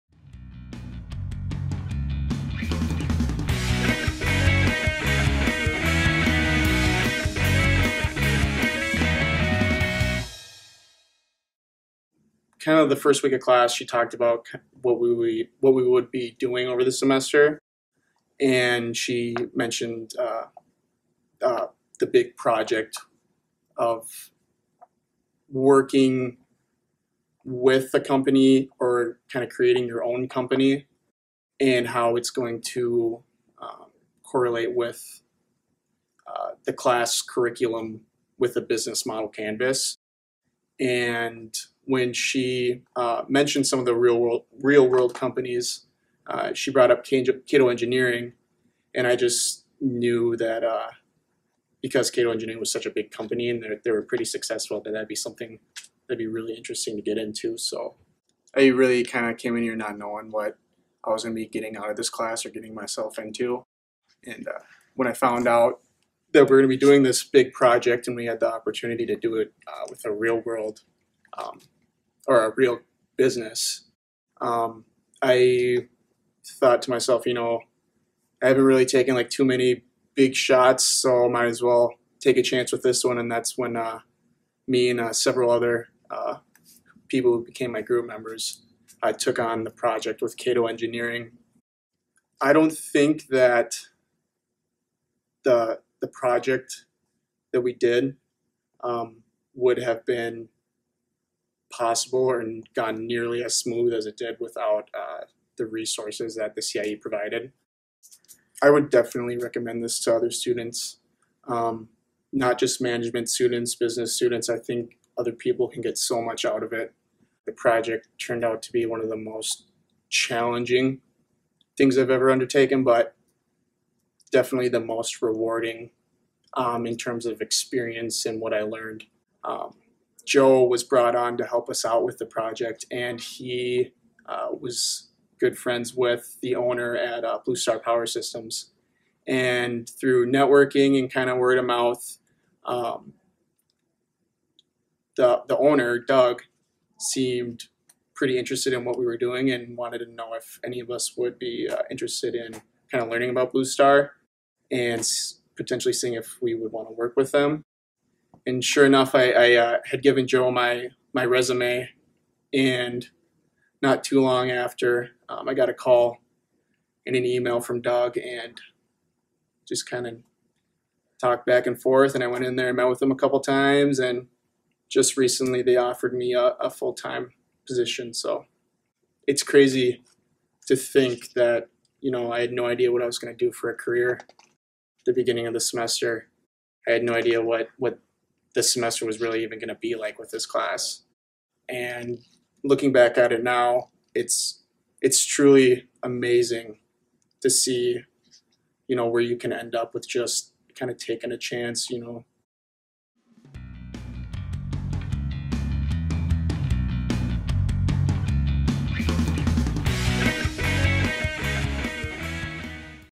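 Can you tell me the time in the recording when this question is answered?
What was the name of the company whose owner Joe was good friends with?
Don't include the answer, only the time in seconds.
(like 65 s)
137 s.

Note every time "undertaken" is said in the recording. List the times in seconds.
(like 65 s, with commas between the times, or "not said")
122 s.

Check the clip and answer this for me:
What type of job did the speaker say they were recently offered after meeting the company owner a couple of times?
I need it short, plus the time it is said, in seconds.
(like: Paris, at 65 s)
full time position, at 176 s.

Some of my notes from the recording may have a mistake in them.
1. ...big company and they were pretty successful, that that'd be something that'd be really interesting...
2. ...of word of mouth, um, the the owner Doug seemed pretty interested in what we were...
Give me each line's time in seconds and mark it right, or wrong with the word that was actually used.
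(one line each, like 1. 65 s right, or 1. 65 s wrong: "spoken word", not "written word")
1. 52 s right
2. 141 s right.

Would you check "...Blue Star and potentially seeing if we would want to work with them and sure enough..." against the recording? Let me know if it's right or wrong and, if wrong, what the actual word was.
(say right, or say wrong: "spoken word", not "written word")
right.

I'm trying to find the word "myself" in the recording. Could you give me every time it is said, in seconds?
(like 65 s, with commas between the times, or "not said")
62 s, 76 s.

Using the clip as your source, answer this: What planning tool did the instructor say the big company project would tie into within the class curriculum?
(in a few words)
business model canvas.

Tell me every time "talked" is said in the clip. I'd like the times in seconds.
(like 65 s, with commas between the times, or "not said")
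13 s, 171 s.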